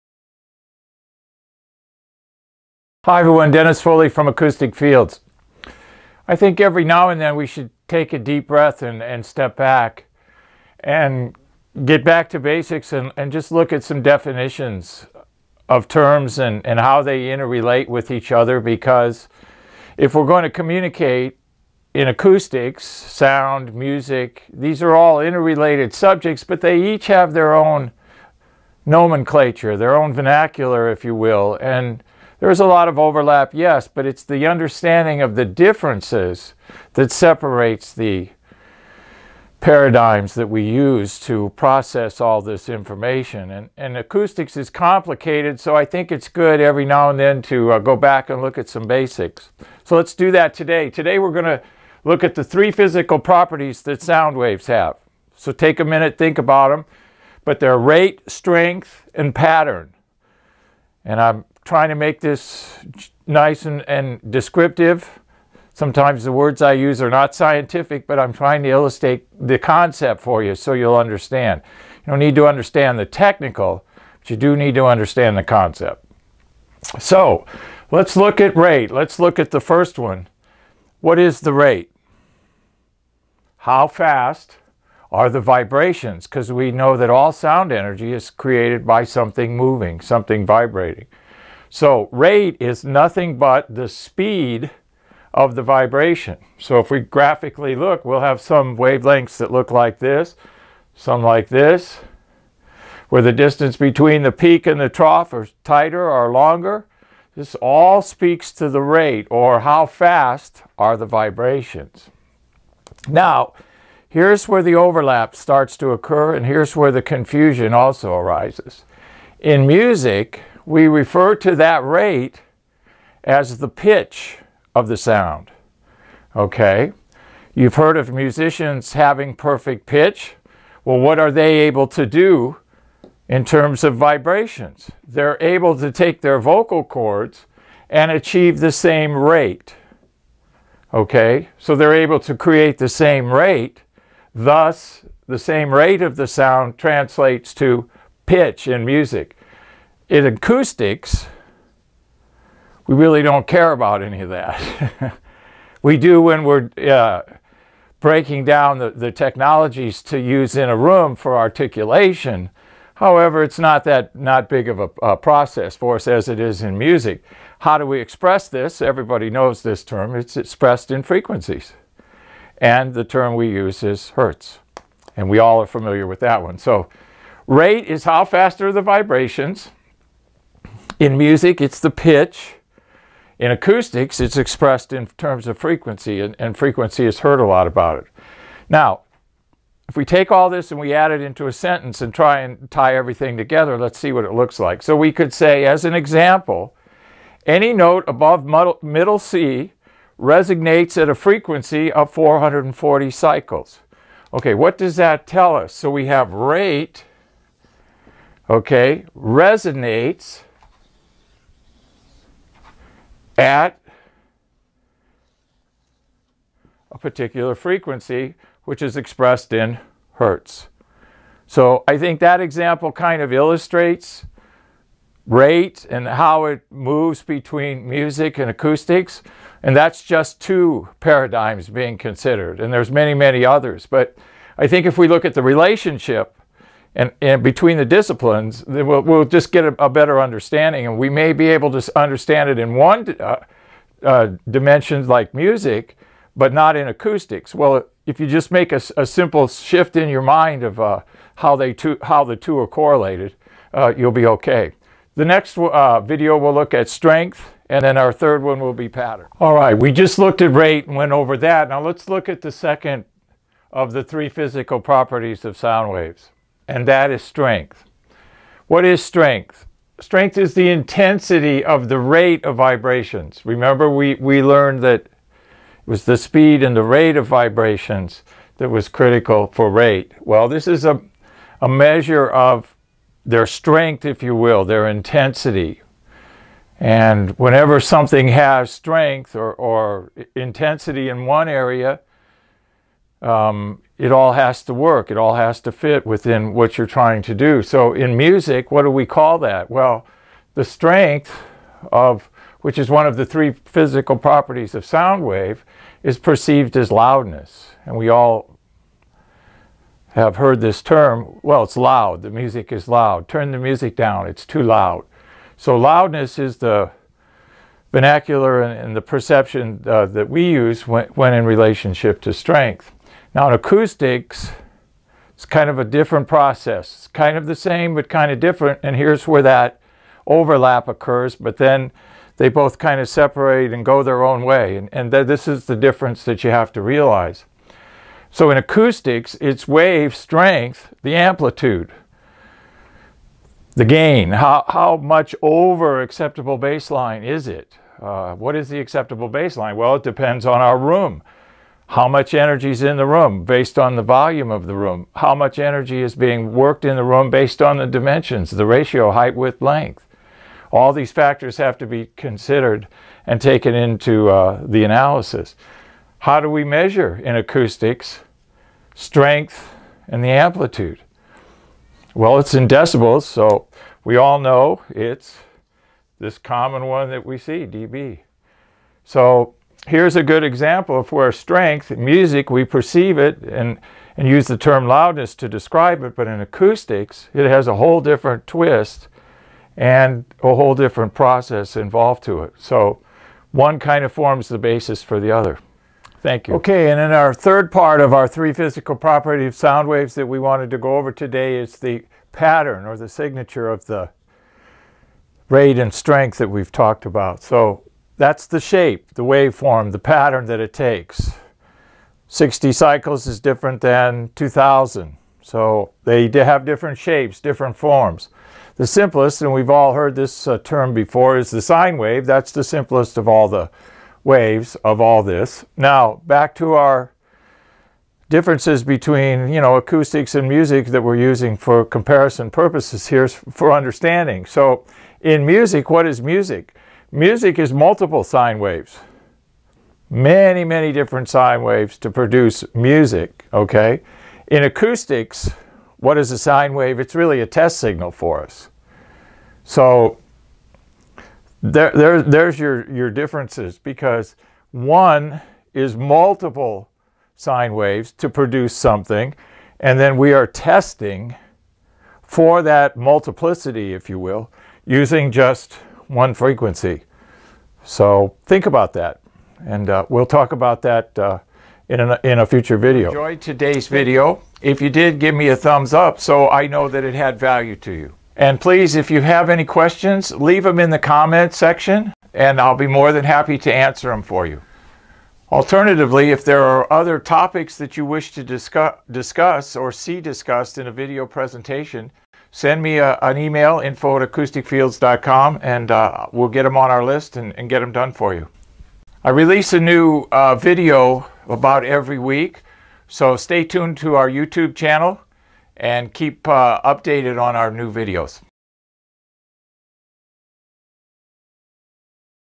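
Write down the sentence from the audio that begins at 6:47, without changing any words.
So that's the shape, the waveform, the pattern that it takes.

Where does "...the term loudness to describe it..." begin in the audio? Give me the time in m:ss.
6:24.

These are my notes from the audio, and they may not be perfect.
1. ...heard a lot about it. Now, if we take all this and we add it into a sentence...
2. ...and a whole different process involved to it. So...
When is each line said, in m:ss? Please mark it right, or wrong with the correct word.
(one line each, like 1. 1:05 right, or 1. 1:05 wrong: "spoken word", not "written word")
1. 3:07 right
2. 6:29 right.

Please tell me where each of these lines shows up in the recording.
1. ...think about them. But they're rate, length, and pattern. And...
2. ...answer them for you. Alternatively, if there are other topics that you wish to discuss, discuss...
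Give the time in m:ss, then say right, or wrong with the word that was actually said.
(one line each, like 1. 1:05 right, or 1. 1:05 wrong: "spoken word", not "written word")
1. 0:56 wrong: "strength", not "length"
2. 8:03 right.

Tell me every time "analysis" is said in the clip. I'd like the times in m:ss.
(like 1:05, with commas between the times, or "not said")
6:04.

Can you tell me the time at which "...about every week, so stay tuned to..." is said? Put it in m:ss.
8:21.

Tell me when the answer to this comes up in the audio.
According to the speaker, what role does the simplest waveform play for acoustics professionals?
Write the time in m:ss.
7:27.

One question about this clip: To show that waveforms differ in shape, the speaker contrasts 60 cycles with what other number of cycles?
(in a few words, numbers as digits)
2,000.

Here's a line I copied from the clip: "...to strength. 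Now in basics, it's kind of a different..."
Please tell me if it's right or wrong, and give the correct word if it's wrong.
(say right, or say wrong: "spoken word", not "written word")
wrong: "acoustics", not "basics".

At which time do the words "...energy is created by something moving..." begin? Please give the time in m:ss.
1:27.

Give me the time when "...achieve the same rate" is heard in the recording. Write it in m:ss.
2:18.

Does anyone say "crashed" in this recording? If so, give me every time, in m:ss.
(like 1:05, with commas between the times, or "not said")
not said.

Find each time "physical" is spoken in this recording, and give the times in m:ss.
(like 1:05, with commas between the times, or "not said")
0:52, 4:24, 5:03, 6:38.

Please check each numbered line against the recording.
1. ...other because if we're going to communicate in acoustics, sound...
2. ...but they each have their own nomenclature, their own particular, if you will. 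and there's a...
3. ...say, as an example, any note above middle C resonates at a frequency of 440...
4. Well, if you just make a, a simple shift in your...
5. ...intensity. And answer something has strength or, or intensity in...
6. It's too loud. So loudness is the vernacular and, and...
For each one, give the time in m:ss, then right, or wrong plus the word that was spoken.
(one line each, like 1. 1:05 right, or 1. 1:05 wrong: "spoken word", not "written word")
1. 0:18 right
2. 0:26 wrong: "vernacular", not "particular"
3. 3:15 right
4. 4:07 right
5. 4:44 wrong: "whenever", not "answer"
6. 5:14 right.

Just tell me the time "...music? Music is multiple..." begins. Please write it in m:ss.
7:16.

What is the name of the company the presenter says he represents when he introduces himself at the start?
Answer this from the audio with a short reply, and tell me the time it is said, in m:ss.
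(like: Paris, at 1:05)
Acoustic Fields, at 0:04.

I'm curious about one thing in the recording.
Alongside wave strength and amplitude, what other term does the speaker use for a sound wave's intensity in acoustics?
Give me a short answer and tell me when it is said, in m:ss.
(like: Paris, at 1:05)
gain, at 5:43.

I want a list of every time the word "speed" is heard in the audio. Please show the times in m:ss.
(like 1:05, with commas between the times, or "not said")
1:33, 4:36.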